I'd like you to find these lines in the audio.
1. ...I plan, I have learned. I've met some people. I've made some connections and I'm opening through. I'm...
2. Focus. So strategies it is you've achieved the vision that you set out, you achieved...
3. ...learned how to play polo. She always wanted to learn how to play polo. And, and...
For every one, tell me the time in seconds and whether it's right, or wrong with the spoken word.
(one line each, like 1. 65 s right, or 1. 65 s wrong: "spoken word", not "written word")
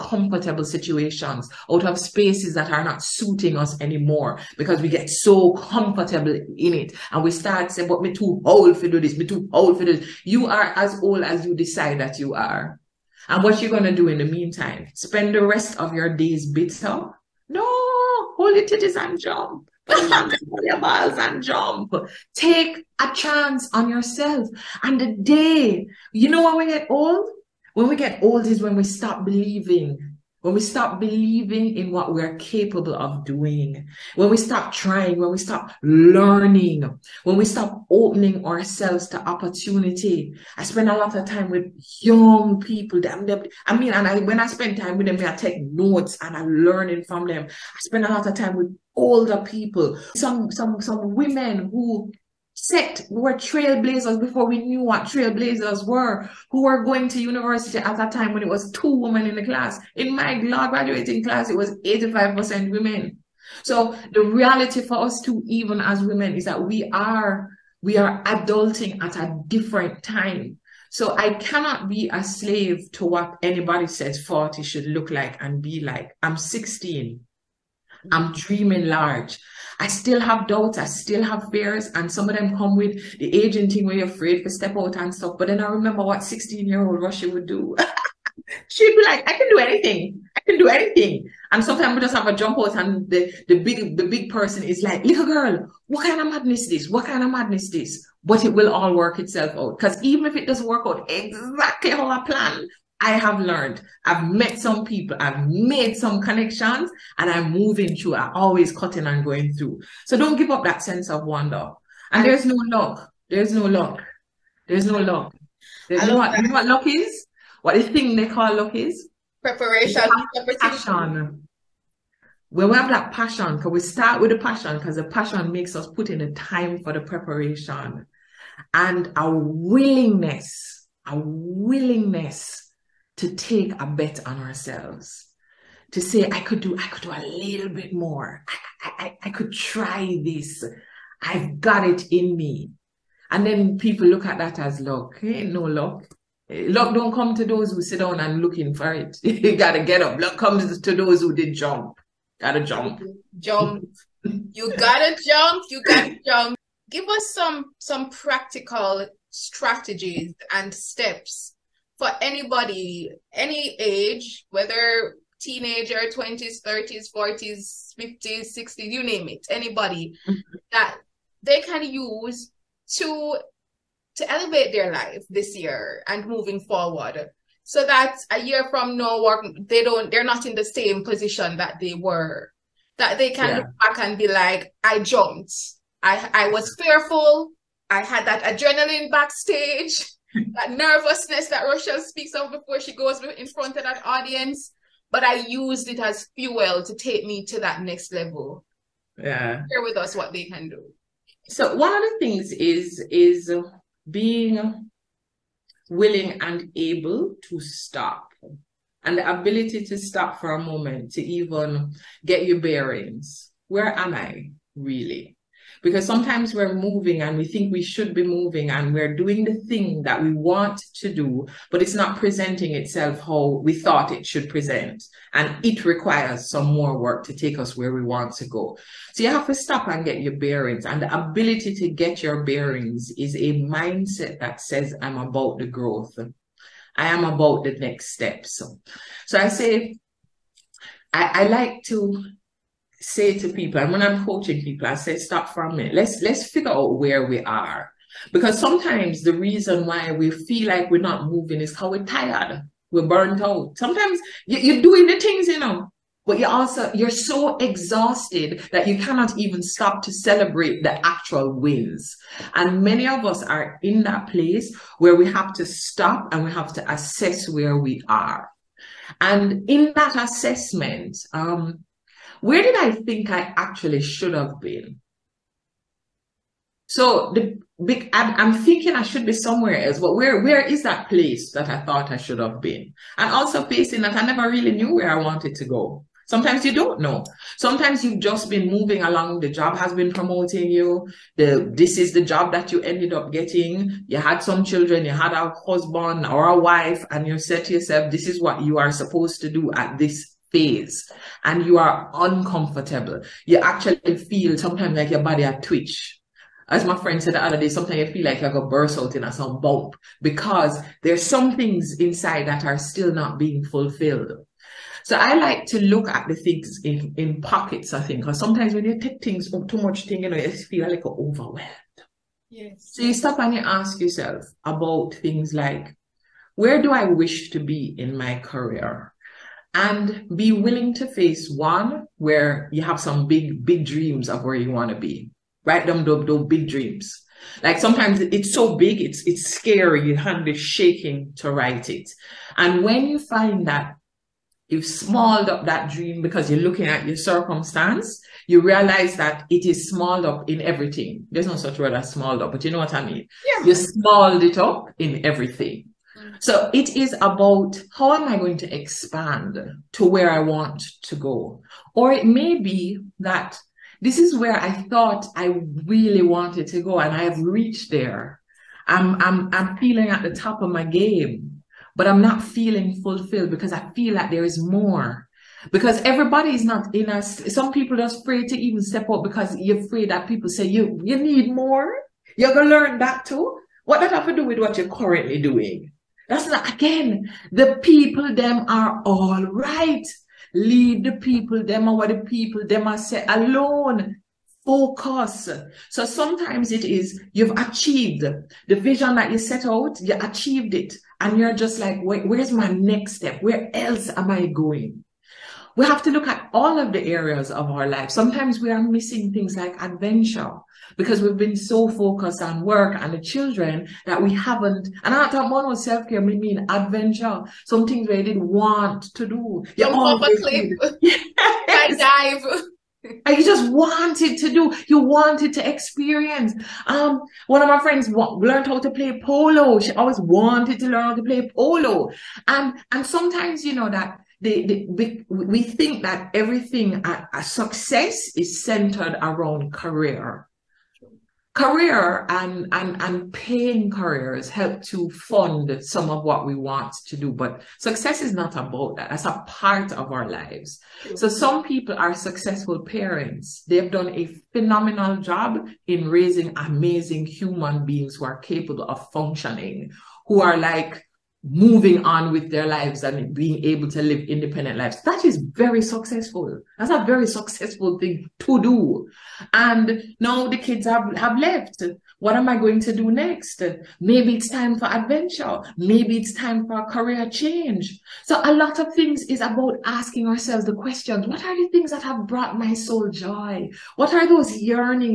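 1. 102 s wrong: "moving", not "opening"
2. 394 s wrong: "sometimes", not "strategies"
3. 428 s right.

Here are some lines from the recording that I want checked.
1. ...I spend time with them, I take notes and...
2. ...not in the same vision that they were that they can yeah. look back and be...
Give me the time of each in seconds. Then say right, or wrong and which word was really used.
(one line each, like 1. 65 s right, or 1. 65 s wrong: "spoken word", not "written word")
1. 44 s right
2. 180 s wrong: "position", not "vision".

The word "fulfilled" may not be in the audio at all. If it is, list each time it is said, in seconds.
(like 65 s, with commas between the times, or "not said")
313 s, 373 s.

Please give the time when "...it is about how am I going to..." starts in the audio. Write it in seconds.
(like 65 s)
356 s.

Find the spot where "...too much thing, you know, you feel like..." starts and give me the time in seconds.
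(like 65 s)
319 s.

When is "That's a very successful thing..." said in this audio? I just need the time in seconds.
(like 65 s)
466 s.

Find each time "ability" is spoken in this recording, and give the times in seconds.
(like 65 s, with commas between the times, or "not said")
209 s, 231 s.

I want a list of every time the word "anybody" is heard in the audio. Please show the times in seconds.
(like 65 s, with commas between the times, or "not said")
73 s, 162 s, 169 s.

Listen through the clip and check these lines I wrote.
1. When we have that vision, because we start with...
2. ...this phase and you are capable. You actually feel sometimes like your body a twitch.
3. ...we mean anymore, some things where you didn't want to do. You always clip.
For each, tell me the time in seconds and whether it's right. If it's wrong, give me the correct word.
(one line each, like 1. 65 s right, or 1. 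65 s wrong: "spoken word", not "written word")
1. 122 s wrong: "passion", not "vision"
2. 299 s wrong: "uncomfortable", not "capable"
3. 416 s wrong: "adventure", not "anymore".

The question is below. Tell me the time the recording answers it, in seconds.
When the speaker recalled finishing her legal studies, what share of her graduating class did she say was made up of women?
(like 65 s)
61 s.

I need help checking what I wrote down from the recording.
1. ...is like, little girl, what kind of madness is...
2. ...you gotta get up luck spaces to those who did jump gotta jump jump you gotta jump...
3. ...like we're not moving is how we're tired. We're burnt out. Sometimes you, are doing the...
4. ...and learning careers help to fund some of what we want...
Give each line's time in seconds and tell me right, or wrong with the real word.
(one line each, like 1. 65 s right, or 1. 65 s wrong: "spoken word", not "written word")
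1. 94 s right
2. 149 s wrong: "comes", not "spaces"
3. 250 s right
4. 443 s wrong: "paying", not "learning".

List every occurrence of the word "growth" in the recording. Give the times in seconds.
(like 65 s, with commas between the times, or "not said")
235 s.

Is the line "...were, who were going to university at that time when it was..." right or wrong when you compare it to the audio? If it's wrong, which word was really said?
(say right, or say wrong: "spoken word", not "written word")
right.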